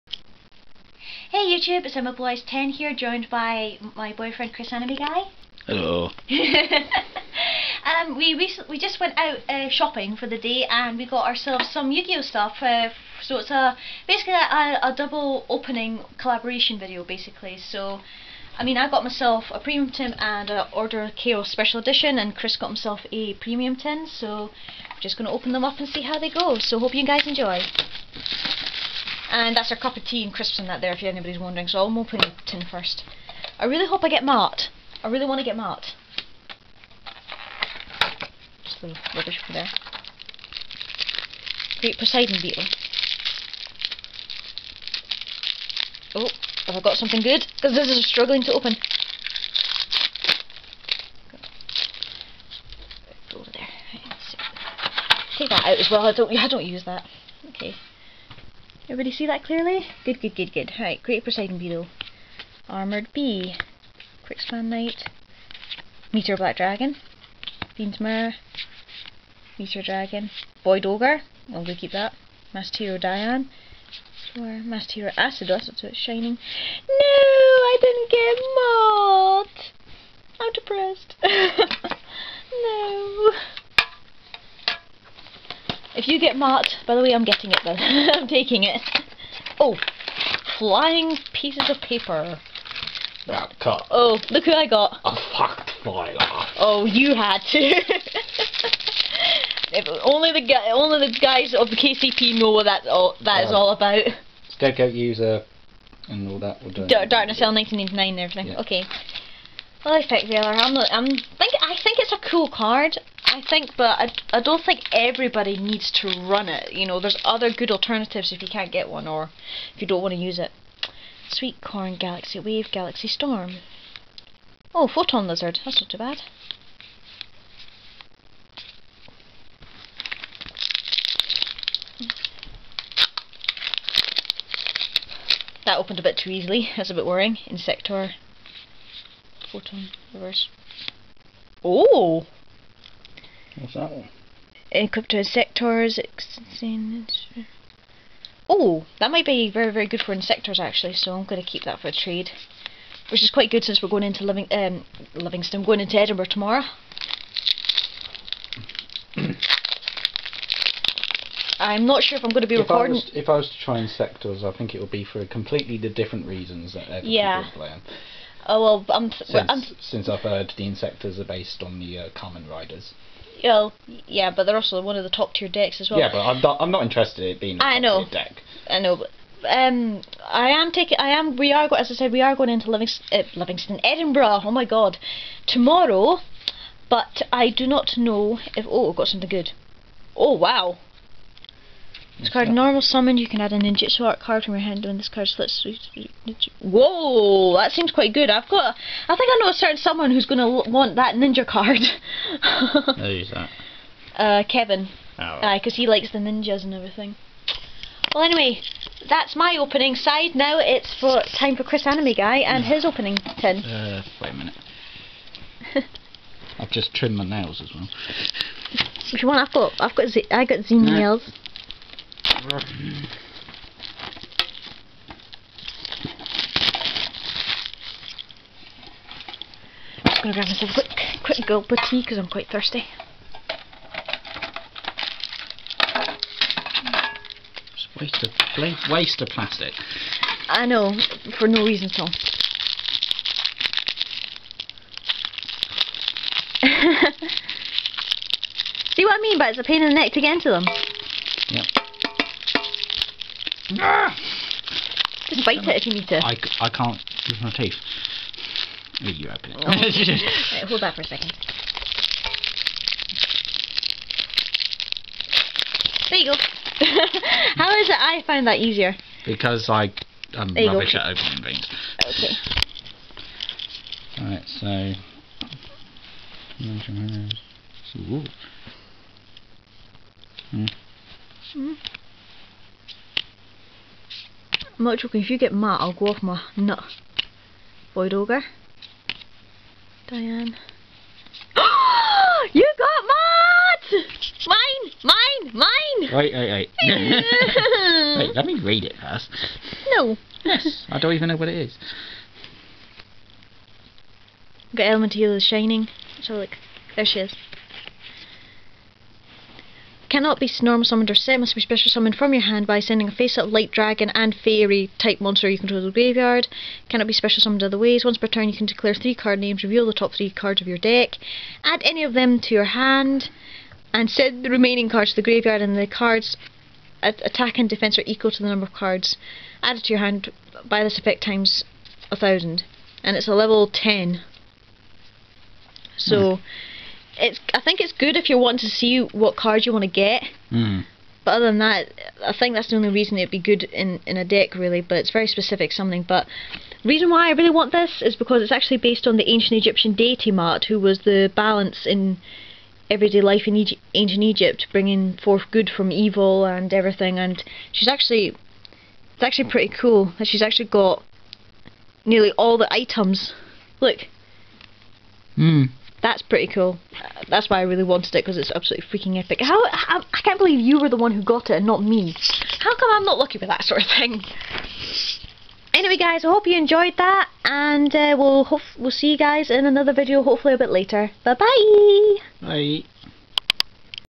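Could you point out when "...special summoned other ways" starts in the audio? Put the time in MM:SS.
05:17.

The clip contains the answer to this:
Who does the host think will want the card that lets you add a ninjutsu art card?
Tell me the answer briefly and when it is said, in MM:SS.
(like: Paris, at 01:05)
Kevin, at 03:24.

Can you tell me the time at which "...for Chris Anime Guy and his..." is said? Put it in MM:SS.
03:31.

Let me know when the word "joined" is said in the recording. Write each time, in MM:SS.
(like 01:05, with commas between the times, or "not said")
00:02.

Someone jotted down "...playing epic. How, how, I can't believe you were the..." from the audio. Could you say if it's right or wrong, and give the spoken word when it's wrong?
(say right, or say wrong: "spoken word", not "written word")
wrong: "freaking", not "playing".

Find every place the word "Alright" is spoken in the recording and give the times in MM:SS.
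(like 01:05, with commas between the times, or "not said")
01:00, 04:34.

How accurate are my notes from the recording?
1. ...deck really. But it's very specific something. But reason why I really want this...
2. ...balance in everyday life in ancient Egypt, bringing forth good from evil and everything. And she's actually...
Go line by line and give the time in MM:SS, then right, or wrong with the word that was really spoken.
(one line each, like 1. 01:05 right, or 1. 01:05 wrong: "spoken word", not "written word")
1. 05:44 right
2. 05:51 right.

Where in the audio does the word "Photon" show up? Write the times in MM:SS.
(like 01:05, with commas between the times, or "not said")
02:04, 02:19.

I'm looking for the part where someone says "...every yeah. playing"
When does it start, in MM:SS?
02:46.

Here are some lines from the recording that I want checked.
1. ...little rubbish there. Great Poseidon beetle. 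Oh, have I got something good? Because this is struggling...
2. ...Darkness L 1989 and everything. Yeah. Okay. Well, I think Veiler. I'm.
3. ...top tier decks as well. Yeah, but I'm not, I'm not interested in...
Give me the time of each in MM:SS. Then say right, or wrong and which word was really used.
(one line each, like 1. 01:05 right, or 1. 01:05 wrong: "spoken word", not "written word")
1. 00:38 right
2. 01:46 right
3. 02:55 right.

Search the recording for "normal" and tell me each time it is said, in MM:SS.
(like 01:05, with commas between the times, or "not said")
03:12, 05:10.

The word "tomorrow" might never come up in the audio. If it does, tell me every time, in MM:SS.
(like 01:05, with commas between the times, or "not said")
02:36, 03:05.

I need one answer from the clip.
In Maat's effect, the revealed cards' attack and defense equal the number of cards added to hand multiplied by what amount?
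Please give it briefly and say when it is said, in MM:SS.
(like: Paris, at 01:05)
1000, at 05:32.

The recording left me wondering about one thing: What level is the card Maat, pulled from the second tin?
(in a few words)
10.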